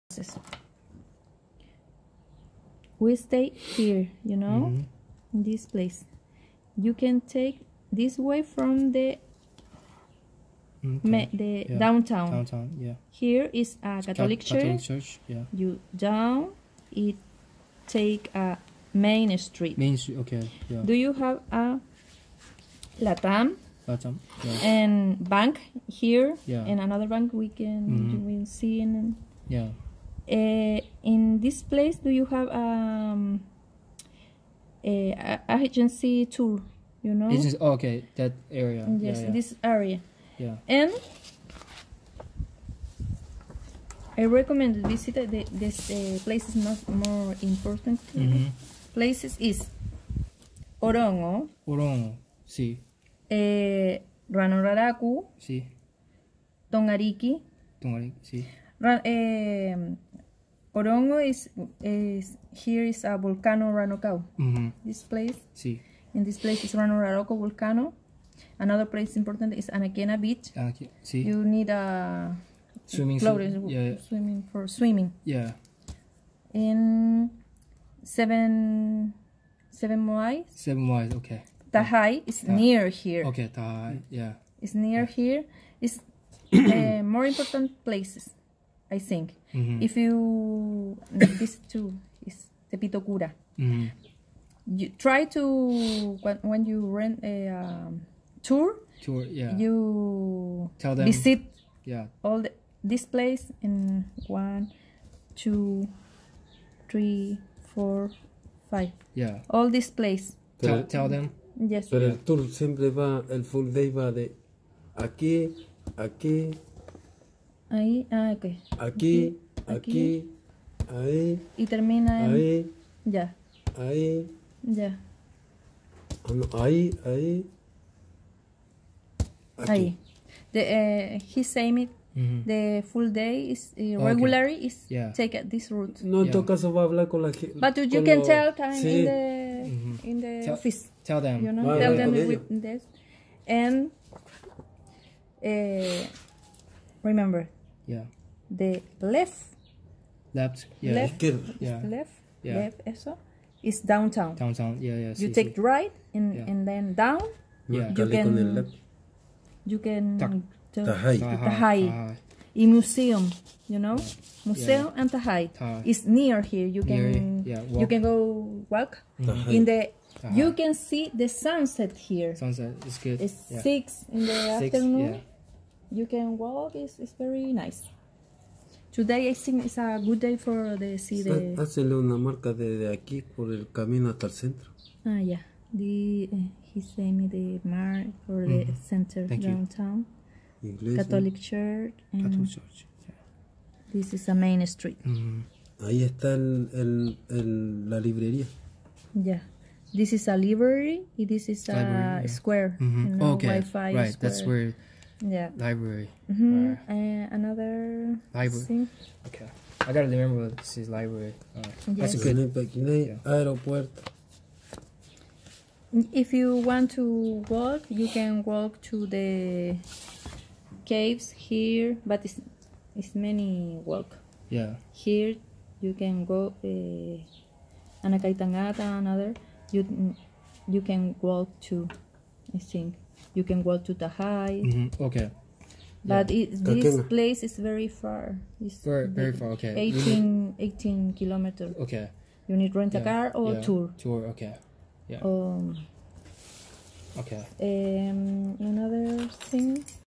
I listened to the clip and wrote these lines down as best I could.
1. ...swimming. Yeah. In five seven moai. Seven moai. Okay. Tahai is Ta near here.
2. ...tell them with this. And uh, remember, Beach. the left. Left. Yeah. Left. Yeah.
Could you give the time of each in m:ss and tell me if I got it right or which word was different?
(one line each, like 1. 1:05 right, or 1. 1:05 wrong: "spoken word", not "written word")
1. 1:14 wrong: "seven", not "five"
2. 2:21 wrong: "Yeah", not "Beach".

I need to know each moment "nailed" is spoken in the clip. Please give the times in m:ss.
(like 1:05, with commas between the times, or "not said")
not said.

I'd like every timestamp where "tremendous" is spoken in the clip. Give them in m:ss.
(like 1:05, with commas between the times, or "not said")
not said.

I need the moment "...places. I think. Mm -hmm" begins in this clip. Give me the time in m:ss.
1:27.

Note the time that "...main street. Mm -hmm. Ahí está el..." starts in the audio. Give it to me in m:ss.
3:14.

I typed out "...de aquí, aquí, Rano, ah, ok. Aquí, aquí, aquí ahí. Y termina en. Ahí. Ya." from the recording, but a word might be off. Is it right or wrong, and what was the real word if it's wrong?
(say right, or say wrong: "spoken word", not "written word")
wrong: "Ahí", not "Rano".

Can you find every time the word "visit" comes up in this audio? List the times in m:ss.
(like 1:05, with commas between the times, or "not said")
0:44, 1:41.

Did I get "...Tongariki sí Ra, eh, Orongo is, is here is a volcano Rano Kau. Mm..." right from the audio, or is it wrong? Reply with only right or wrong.
right.